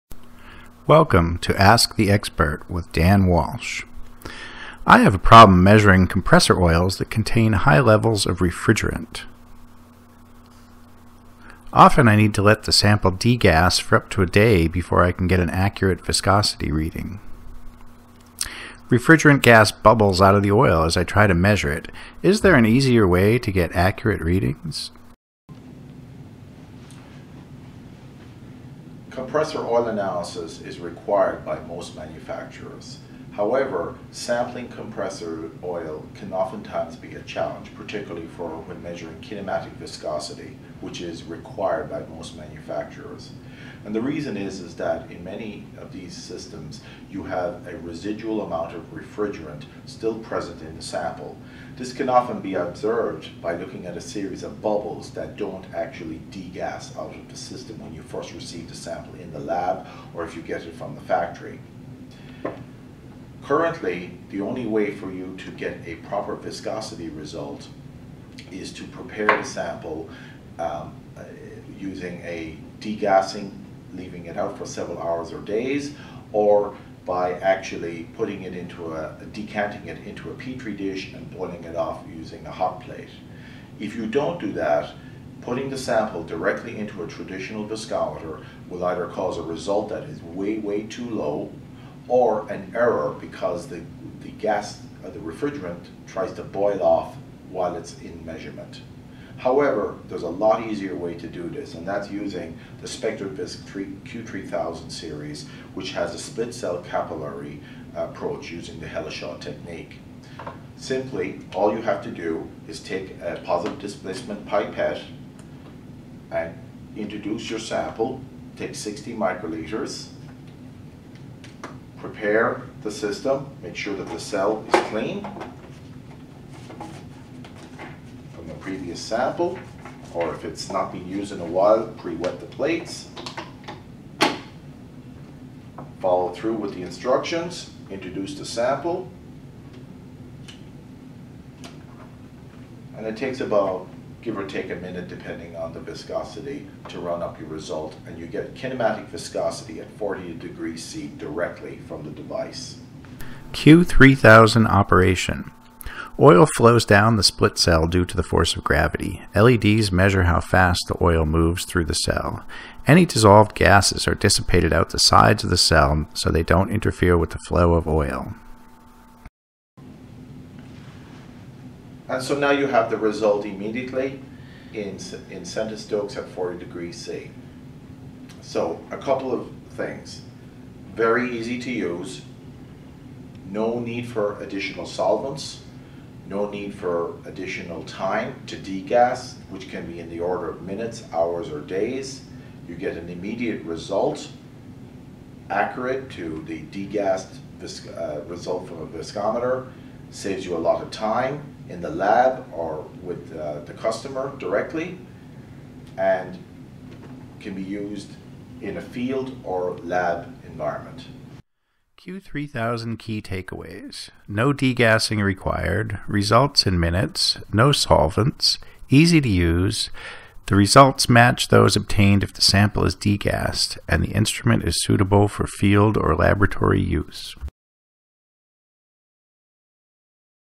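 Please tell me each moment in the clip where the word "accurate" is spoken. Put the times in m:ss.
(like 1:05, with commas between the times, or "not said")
0:15, 0:23, 3:15.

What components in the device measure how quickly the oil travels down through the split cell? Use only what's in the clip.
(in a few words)
LEDs.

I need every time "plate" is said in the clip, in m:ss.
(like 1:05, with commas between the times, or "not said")
1:22, 2:12.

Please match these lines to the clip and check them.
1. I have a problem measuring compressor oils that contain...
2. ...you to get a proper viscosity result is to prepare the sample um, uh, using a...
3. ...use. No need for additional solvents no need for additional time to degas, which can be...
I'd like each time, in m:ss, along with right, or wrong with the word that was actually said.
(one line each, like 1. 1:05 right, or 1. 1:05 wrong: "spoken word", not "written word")
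1. 0:04 right
2. 1:05 right
3. 3:01 right.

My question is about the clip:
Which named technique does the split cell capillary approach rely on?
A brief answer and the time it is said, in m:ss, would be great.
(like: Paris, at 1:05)
Hele-Shaw, at 1:48.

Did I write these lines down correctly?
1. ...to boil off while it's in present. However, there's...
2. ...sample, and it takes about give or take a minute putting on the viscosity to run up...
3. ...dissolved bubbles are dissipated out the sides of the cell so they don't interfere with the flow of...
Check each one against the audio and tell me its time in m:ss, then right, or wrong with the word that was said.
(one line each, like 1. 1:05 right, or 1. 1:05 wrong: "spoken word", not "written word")
1. 1:36 wrong: "measurement", not "present"
2. 2:18 wrong: "depending", not "putting"
3. 2:43 wrong: "gases", not "bubbles".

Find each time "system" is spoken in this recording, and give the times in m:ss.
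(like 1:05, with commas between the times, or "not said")
0:46, 0:57, 2:02.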